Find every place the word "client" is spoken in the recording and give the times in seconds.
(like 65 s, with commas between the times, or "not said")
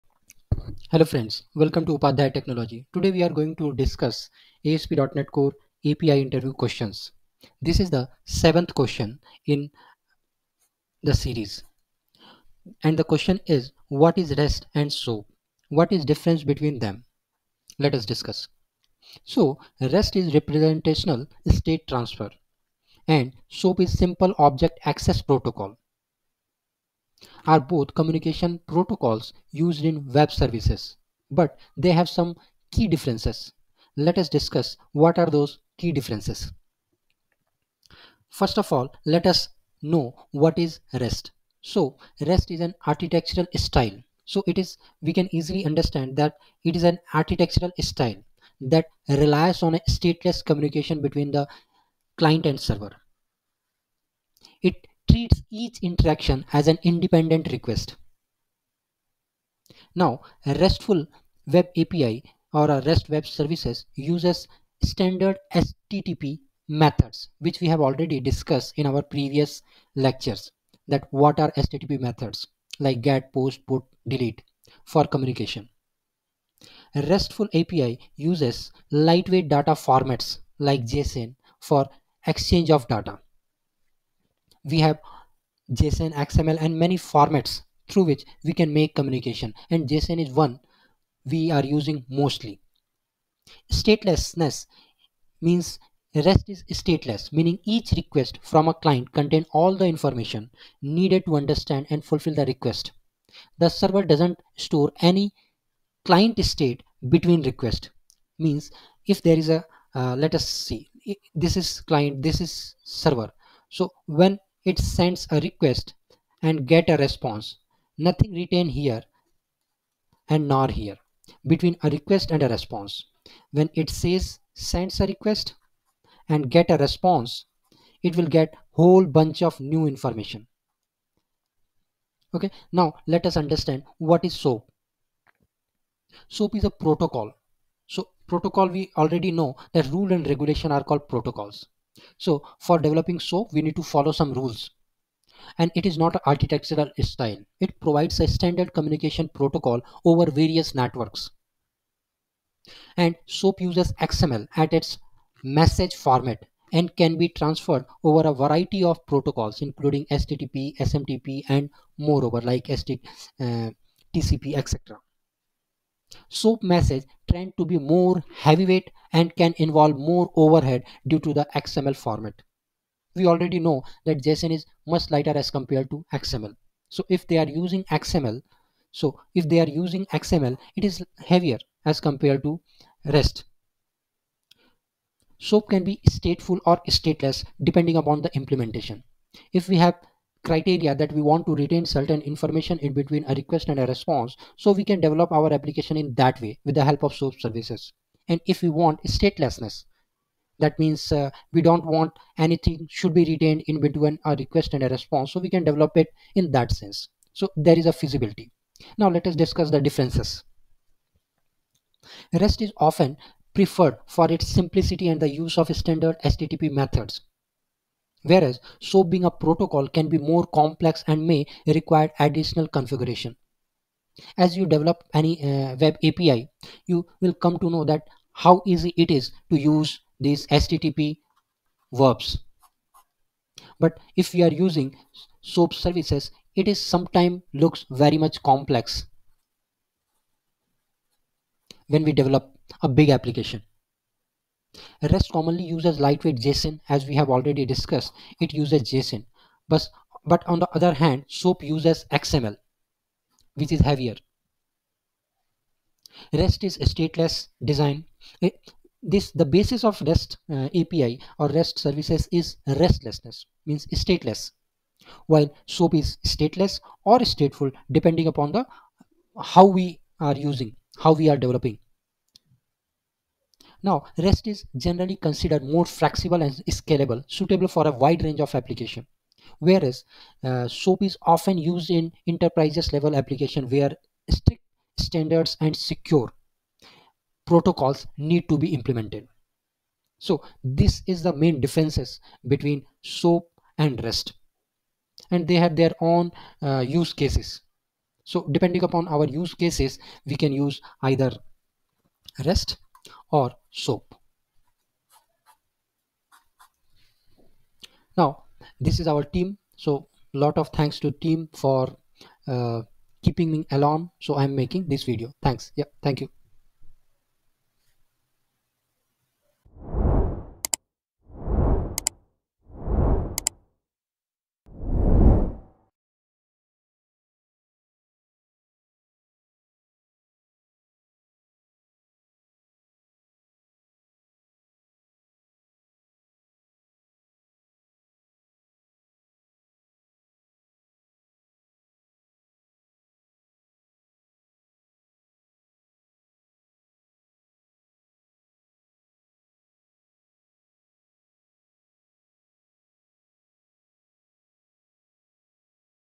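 52 s, 98 s, 106 s, 111 s.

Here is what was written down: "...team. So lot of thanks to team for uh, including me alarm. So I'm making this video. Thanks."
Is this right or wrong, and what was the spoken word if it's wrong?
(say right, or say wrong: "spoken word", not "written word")
wrong: "keeping", not "including".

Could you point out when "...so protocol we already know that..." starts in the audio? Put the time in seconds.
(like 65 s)
137 s.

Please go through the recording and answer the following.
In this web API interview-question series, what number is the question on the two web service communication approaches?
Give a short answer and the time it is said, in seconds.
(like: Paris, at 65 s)
7th, at 8 s.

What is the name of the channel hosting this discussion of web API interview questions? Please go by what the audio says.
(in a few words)
Upadhyay Technology.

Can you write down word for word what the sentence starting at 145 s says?
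And it is not an architectural style.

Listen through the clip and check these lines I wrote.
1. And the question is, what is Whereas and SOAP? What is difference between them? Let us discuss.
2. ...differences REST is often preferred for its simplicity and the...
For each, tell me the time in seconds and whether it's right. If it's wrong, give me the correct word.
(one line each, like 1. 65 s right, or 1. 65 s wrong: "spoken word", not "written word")
1. 12 s wrong: "REST", not "Whereas"
2. 209 s right.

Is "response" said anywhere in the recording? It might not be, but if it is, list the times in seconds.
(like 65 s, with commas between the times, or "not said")
117 s, 122 s, 126 s, 193 s, 204 s.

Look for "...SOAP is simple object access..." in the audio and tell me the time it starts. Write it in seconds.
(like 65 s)
23 s.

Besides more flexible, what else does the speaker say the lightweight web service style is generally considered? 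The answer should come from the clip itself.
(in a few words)
Scalable.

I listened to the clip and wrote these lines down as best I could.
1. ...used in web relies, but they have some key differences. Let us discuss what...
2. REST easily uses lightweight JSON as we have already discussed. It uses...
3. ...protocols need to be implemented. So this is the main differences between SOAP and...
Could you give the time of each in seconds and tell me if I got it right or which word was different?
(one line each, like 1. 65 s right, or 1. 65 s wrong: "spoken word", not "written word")
1. 29 s wrong: "services", not "relies"
2. 245 s wrong: "commonly", not "easily"
3. 287 s right.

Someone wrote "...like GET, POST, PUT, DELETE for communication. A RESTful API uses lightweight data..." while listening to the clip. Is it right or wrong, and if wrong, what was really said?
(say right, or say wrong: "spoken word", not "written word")
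right.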